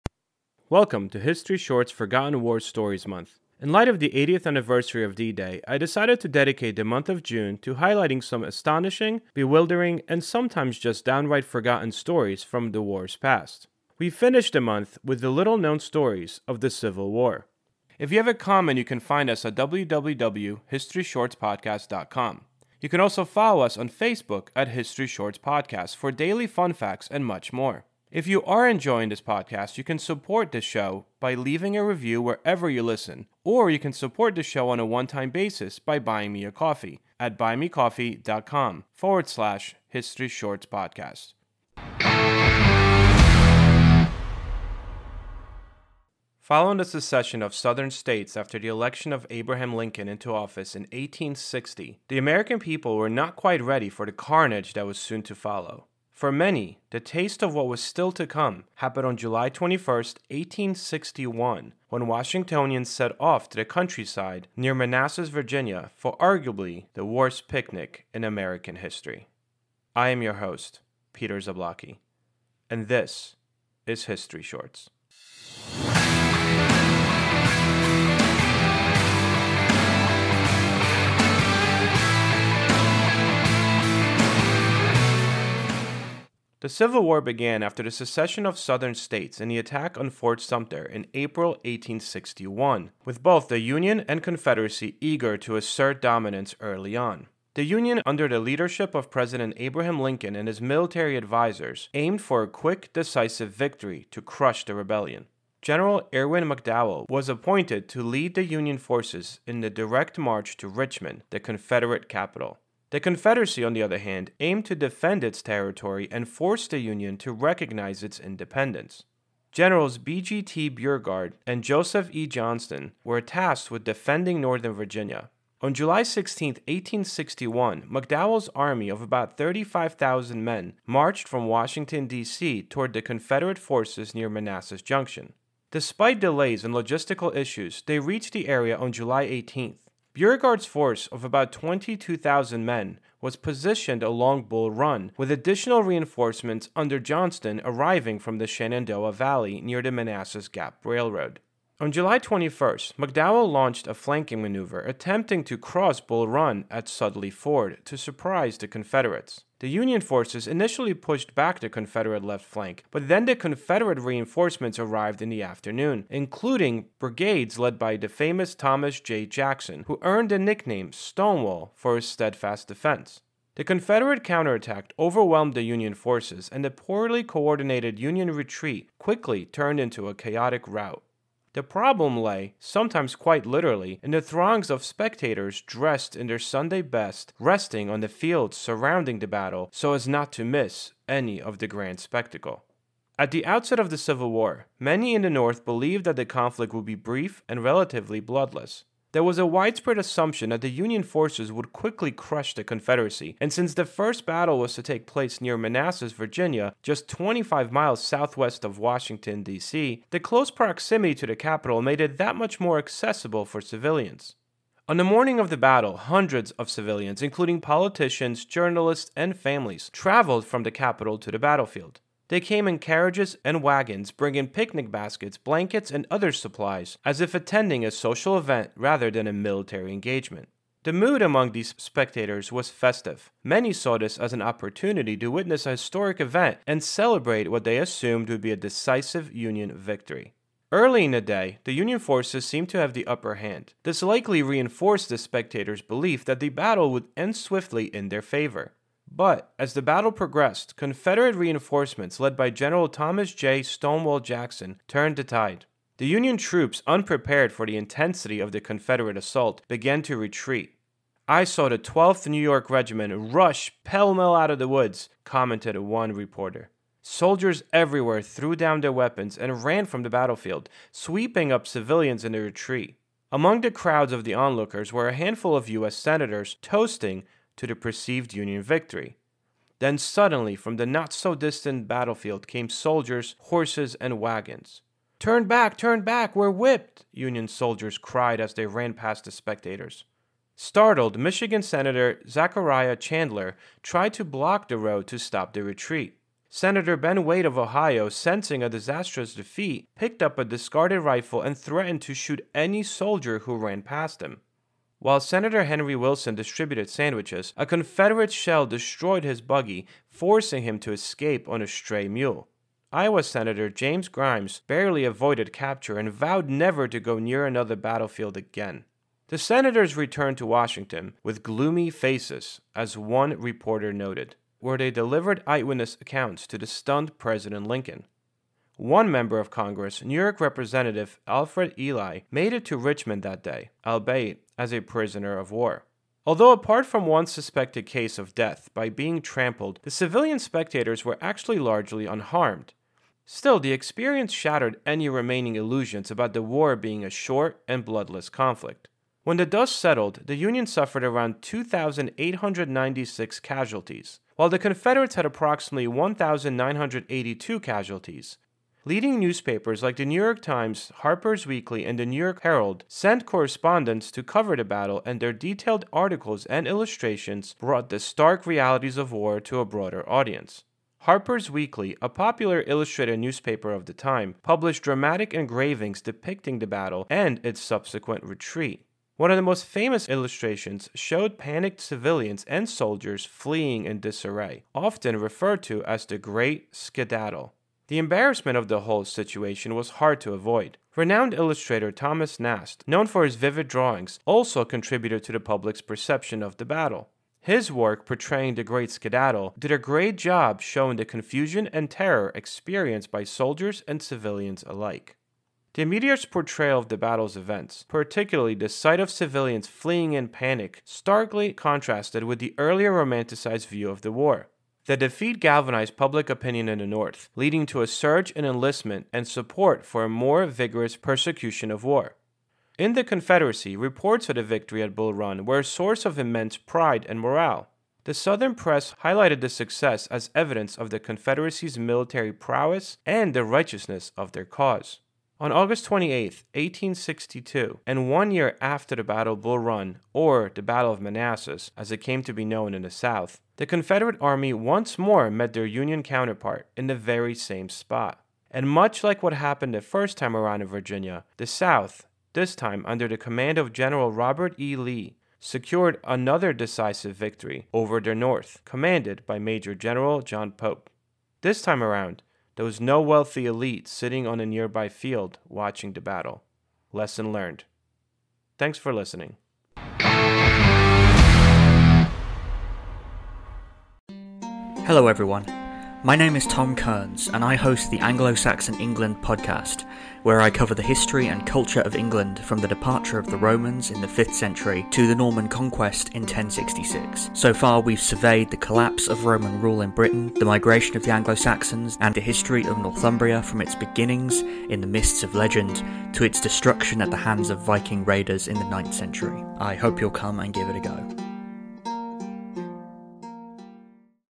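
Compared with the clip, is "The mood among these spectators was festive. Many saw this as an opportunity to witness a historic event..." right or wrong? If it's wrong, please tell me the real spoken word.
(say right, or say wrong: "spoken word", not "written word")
right.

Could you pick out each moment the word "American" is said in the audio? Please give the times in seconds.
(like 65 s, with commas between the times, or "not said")
52 s, 68 s.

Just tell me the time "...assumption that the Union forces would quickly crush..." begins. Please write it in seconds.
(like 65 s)
199 s.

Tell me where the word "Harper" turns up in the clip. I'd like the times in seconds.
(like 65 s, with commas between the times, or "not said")
361 s, 371 s.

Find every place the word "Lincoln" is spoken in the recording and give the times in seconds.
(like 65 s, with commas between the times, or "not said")
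49 s, 99 s, 327 s.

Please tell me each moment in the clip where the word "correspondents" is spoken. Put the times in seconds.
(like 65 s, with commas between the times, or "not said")
363 s.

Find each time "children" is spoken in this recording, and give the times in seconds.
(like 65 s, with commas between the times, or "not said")
not said.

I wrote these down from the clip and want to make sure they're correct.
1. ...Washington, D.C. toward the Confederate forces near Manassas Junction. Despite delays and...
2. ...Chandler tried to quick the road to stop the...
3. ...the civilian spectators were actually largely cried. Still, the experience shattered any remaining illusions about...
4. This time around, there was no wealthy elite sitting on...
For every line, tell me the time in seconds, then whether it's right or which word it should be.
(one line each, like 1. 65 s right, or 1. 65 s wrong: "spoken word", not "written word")
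1. 131 s right
2. 292 s wrong: "block", not "quick"
3. 339 s wrong: "unharmed", not "cried"
4. 461 s right.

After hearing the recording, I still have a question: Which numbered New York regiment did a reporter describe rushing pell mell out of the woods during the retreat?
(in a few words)
12th.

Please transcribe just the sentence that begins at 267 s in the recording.
Soldiers everywhere threw down their weapons and ran from the battlefield, sweeping up civilians in their retreat.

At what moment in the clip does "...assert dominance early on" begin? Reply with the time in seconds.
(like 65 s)
95 s.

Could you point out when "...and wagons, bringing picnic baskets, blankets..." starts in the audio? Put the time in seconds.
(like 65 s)
223 s.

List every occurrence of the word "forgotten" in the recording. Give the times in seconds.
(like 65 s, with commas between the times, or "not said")
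1 s, 11 s.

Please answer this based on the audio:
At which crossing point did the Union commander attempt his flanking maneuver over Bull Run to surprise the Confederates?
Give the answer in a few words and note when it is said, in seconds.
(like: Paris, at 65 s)
Sudley Ford, at 156 s.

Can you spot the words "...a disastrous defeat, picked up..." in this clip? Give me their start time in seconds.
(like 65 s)
298 s.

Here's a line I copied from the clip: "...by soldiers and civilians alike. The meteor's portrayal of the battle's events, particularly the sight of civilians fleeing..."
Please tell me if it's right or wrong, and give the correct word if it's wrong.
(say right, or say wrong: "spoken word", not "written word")
right.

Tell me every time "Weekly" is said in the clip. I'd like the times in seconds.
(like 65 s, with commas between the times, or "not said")
361 s, 371 s.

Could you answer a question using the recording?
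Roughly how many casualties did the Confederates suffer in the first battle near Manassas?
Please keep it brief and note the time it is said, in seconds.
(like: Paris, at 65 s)
1,982, at 355 s.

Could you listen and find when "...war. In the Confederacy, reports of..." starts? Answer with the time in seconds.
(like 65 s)
421 s.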